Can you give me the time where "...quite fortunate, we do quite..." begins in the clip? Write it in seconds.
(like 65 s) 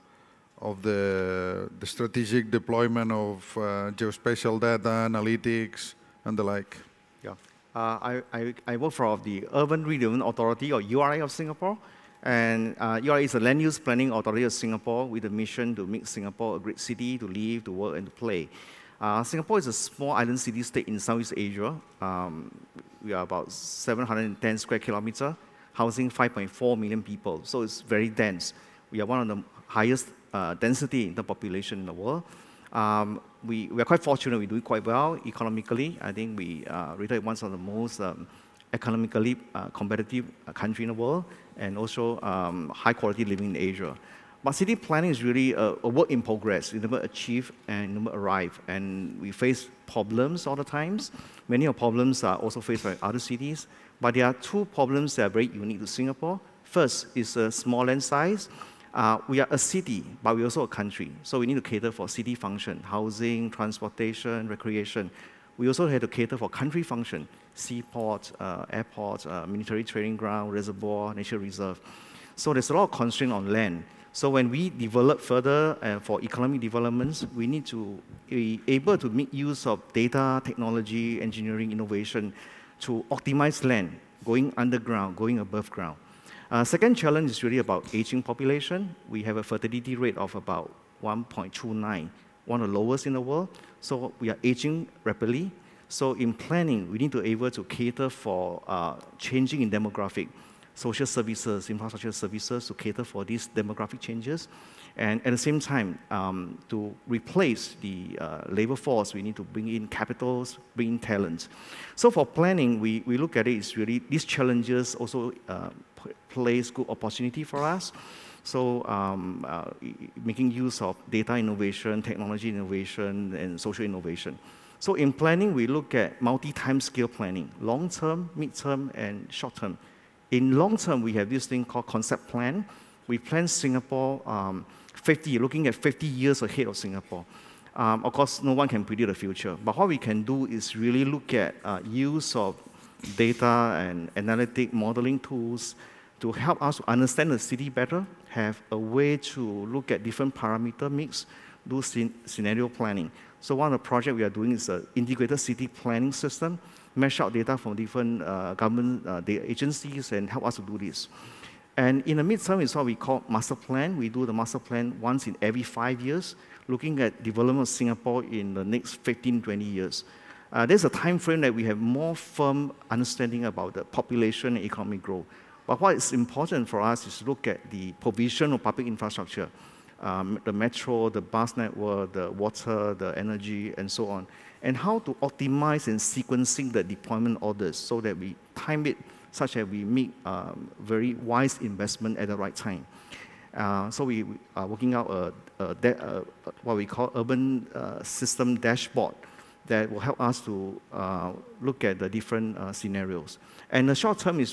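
33 s.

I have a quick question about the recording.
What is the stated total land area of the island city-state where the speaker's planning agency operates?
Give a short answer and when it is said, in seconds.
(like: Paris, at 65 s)
710 square kilometers, at 23 s.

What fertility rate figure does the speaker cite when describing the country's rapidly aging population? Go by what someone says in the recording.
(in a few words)
1.29.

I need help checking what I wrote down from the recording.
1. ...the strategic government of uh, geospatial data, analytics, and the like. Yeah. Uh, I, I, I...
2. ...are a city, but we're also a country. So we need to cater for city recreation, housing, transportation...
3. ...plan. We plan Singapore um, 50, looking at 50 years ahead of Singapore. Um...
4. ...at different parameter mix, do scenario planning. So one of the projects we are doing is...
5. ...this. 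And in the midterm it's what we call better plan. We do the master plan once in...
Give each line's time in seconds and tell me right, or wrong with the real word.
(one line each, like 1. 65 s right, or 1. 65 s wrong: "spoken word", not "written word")
1. 1 s wrong: "deployment", not "government"
2. 59 s wrong: "function", not "recreation"
3. 132 s right
4. 149 s right
5. 160 s wrong: "master", not "better".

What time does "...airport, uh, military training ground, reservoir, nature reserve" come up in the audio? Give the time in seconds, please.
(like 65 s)
68 s.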